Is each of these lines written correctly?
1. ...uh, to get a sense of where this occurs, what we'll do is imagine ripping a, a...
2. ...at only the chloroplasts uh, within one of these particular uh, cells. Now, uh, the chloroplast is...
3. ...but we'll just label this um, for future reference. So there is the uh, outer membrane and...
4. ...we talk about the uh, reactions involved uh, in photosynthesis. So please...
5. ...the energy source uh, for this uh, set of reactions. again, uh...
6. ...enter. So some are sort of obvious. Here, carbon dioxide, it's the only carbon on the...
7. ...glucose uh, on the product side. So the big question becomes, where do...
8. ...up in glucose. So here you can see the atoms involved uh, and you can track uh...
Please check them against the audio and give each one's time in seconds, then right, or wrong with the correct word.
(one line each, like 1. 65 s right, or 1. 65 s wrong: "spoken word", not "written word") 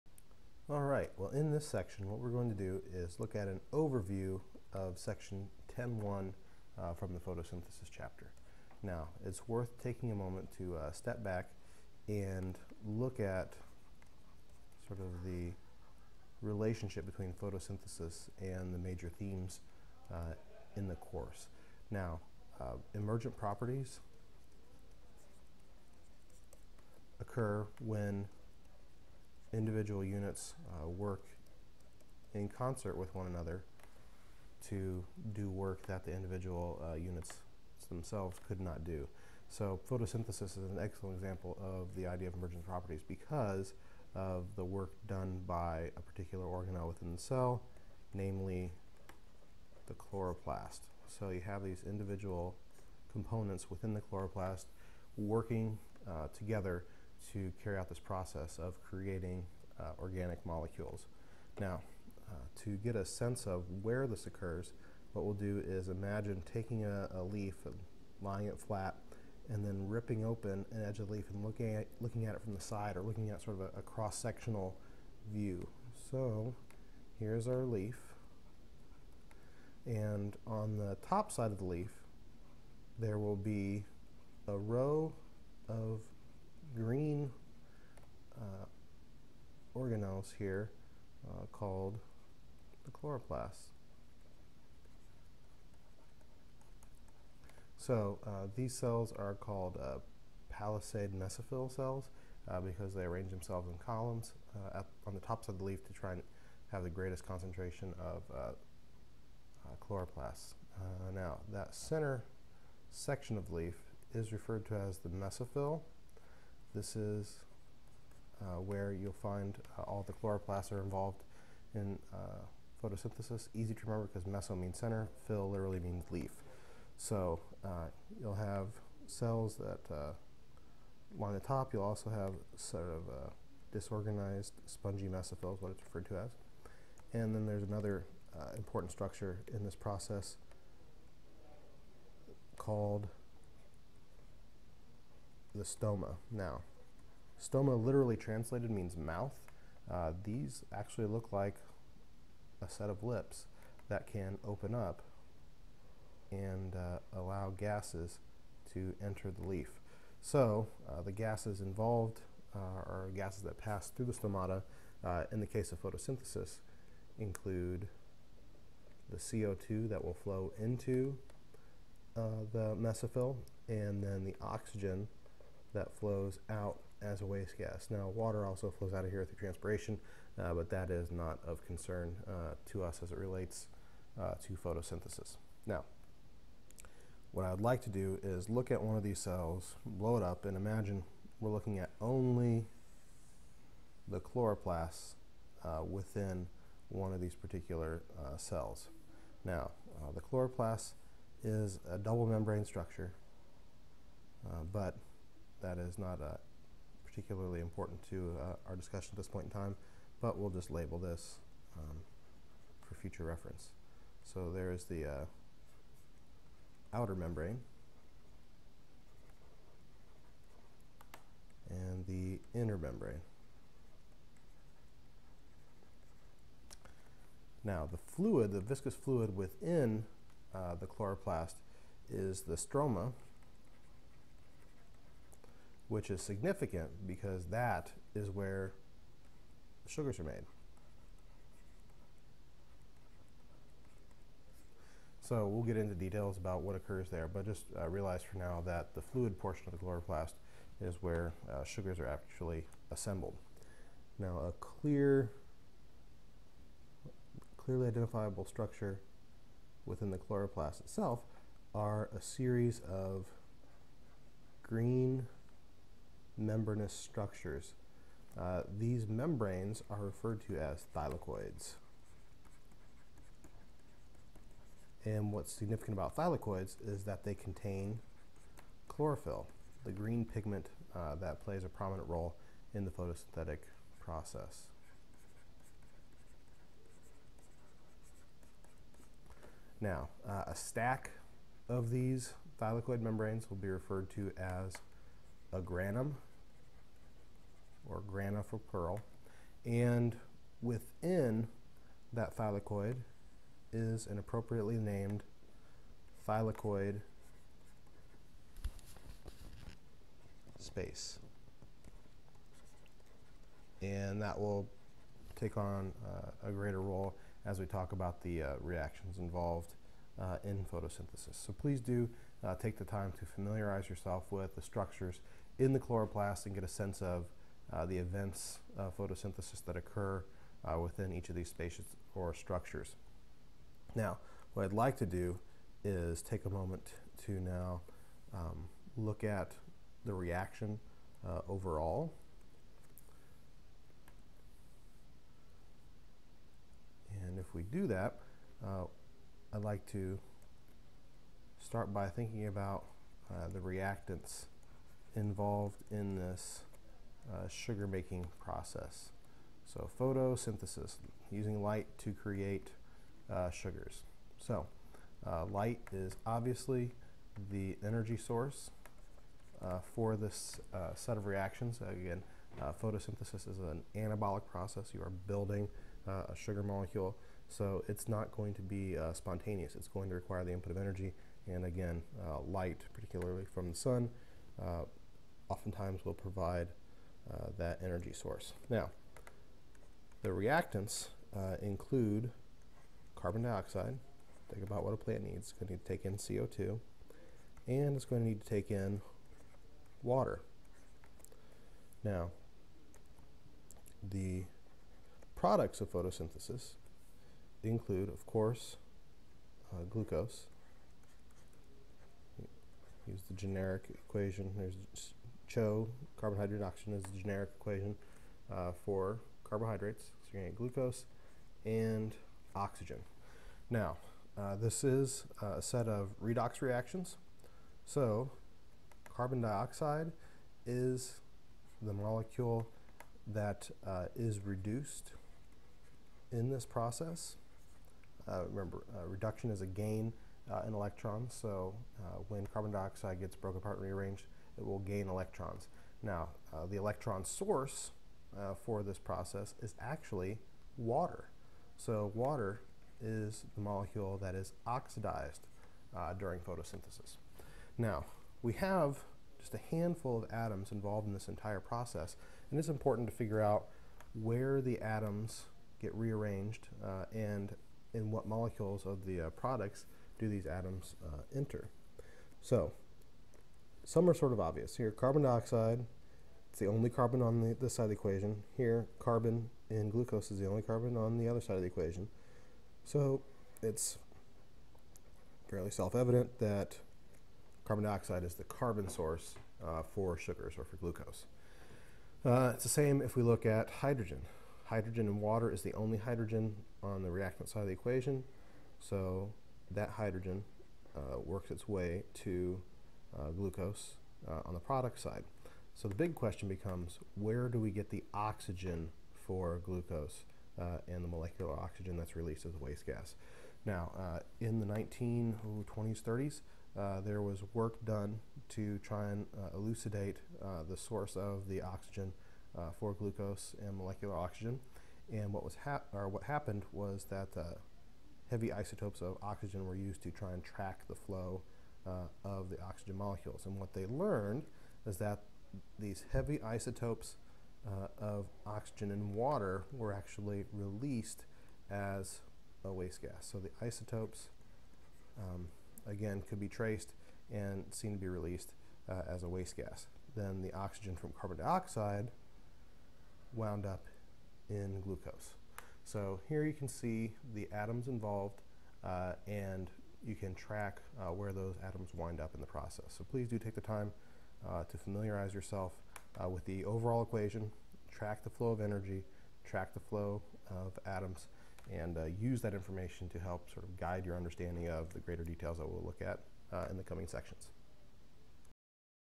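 1. 62 s wrong: "taking", not "ripping"
2. 191 s right
3. 210 s right
4. 317 s right
5. 367 s right
6. 471 s right
7. 503 s right
8. 553 s right.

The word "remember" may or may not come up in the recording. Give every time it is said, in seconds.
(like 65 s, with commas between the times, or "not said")
123 s, 438 s.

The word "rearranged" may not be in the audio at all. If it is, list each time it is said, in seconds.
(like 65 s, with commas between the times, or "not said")
443 s, 465 s.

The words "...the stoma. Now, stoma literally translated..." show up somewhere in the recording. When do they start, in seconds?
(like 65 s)
145 s.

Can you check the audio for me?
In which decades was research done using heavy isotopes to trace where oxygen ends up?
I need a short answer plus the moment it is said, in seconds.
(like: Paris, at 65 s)
1920s and 1930s, at 514 s.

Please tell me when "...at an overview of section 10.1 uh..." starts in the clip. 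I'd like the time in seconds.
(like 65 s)
3 s.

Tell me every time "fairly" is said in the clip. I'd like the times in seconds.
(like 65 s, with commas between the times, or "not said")
485 s.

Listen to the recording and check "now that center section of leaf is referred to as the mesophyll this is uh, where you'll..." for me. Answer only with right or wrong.
right.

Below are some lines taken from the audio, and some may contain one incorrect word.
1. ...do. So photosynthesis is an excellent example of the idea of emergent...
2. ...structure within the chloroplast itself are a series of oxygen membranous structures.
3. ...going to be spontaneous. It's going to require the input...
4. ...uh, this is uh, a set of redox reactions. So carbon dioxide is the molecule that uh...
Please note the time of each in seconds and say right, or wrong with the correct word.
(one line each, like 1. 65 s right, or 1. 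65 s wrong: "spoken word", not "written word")
1. 38 s right
2. 258 s wrong: "green", not "oxygen"
3. 378 s right
4. 424 s right.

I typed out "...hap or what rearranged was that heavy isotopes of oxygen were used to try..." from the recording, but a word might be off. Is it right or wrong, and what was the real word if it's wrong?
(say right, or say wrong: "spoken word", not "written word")
wrong: "happened", not "rearranged".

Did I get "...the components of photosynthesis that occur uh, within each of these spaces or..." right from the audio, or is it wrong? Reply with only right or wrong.
wrong.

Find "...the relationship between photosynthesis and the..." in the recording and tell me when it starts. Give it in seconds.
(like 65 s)
15 s.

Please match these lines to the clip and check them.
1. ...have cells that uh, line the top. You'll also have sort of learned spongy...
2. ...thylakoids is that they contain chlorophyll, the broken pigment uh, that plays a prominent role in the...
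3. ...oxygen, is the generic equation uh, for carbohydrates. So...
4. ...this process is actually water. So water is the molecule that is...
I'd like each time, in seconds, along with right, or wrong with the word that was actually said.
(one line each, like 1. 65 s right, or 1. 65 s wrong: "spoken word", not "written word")
1. 128 s wrong: "disorganized", not "learned"
2. 276 s wrong: "green", not "broken"
3. 416 s right
4. 448 s right.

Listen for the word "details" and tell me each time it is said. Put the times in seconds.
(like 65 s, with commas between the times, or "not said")
245 s, 575 s.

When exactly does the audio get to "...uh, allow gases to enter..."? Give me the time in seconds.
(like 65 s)
156 s.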